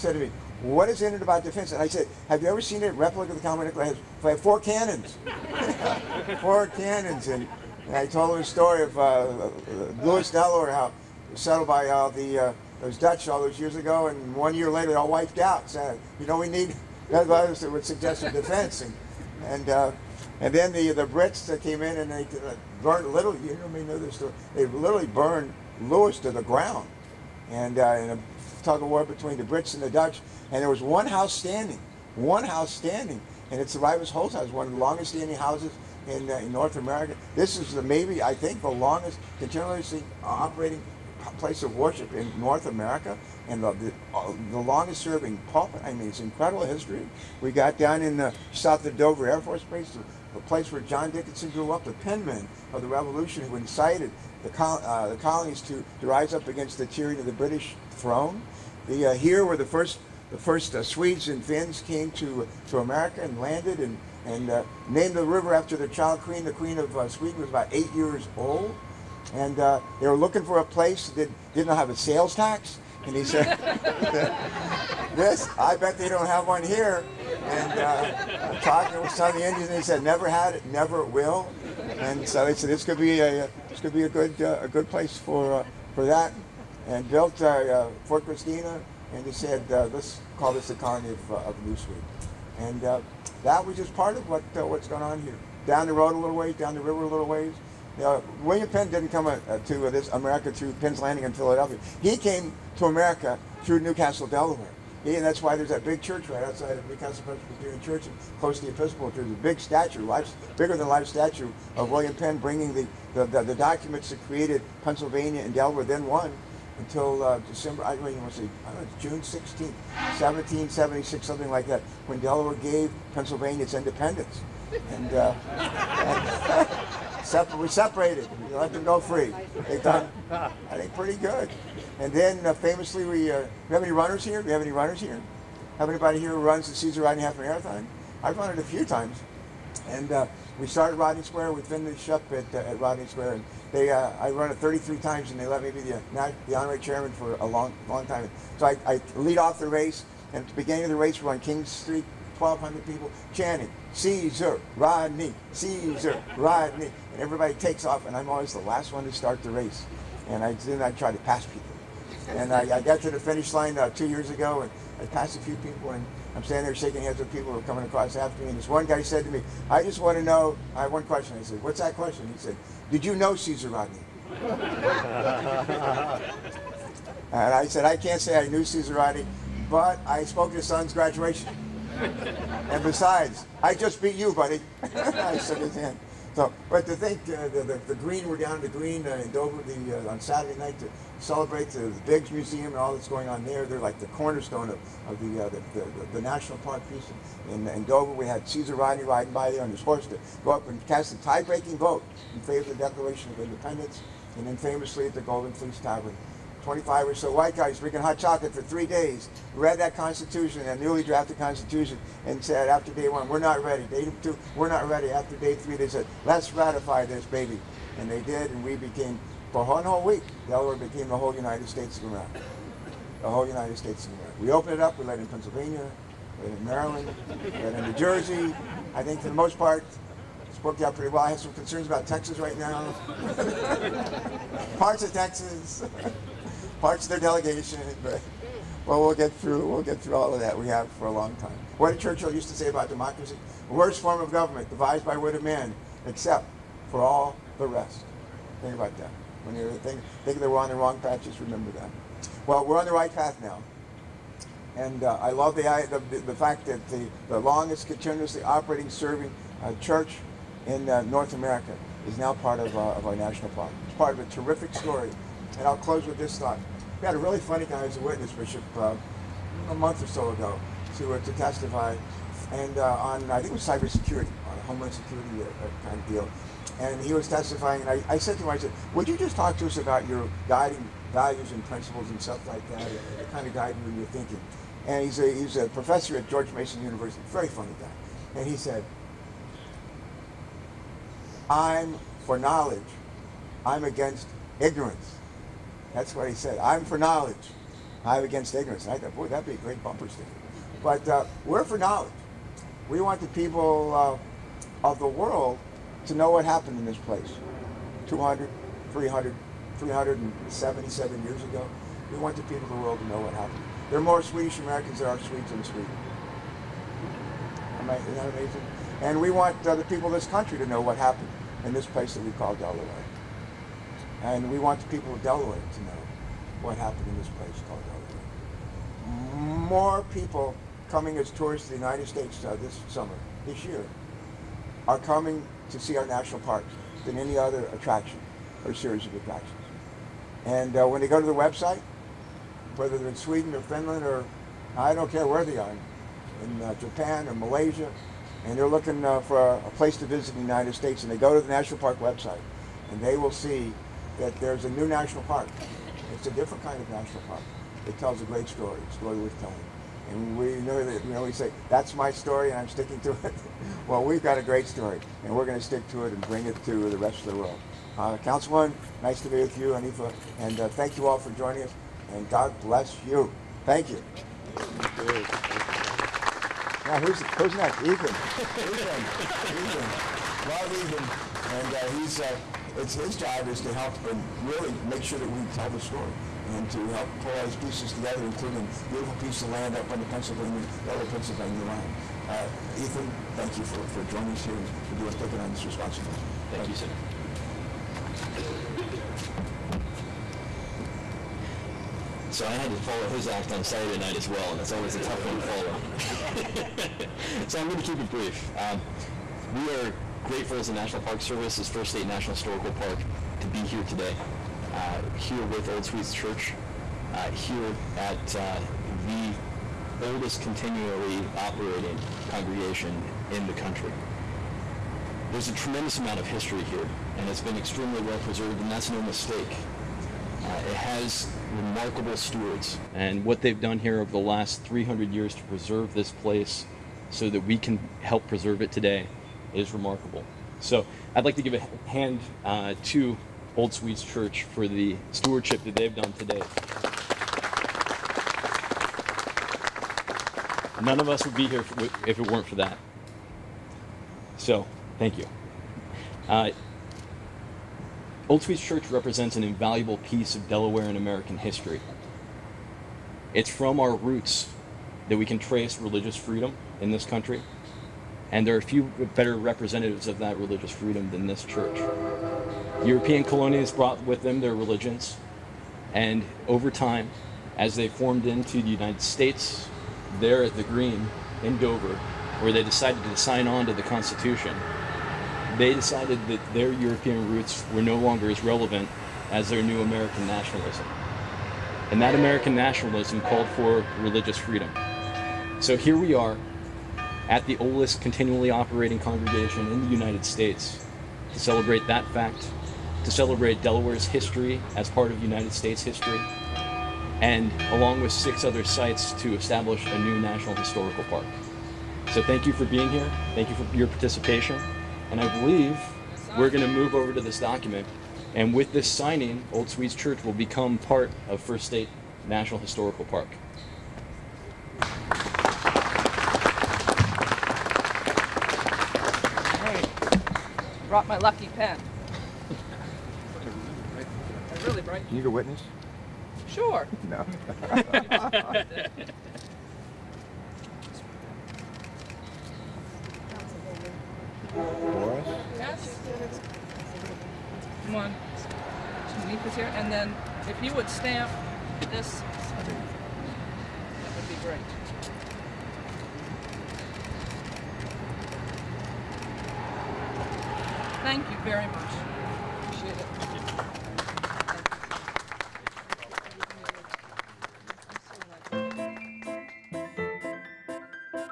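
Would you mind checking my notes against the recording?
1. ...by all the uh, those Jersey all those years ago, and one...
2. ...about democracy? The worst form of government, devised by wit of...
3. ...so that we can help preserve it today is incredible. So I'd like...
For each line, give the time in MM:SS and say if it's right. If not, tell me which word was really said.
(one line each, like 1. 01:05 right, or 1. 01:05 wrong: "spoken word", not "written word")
1. 00:11 wrong: "Dutch", not "Jersey"
2. 04:02 right
3. 07:17 wrong: "remarkable", not "incredible".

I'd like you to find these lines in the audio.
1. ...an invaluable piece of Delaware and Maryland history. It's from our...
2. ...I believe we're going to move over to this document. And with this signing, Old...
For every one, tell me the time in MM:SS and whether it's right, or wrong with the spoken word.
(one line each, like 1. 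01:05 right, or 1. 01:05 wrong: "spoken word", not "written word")
1. 07:39 wrong: "American", not "Maryland"
2. 08:35 right.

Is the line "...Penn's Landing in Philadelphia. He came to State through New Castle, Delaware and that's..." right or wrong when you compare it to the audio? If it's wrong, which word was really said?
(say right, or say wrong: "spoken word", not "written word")
wrong: "America", not "State".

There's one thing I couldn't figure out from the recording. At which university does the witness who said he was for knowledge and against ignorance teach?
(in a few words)
George Mason University.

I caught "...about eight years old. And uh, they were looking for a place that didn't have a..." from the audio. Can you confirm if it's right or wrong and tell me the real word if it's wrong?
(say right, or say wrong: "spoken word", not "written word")
right.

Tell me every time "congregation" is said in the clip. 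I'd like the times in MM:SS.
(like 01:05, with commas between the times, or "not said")
07:02, 08:18.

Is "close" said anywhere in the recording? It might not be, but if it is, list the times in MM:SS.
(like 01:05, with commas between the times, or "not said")
01:48, 04:25.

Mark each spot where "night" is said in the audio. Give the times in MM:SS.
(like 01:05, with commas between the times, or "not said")
03:10, 06:43.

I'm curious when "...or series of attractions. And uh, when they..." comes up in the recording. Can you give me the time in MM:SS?
05:38.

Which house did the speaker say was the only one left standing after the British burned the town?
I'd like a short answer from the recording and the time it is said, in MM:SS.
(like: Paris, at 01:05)
Ryves Holt House, at 00:33.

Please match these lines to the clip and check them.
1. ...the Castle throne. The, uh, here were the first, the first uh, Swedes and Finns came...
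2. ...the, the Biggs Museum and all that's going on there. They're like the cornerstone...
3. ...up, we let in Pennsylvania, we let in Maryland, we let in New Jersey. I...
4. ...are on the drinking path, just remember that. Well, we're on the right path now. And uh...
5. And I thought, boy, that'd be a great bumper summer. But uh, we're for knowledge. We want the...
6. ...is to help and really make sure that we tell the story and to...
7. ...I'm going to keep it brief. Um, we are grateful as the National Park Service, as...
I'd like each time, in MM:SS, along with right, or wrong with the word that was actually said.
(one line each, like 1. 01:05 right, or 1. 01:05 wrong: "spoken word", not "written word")
1. 00:57 wrong: "British", not "Castle"
2. 03:11 right
3. 03:44 right
4. 04:10 wrong: "wrong", not "drinking"
5. 04:58 wrong: "sticker", not "summer"
6. 06:23 right
7. 06:47 right.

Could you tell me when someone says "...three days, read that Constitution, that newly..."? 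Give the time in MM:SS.
03:28.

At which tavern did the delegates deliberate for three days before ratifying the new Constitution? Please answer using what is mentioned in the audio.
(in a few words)
Golden Fleece Tavern.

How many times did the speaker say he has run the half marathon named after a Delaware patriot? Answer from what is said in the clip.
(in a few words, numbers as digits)
33.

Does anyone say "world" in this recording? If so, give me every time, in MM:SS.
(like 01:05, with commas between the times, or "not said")
05:05, 05:12, 06:07.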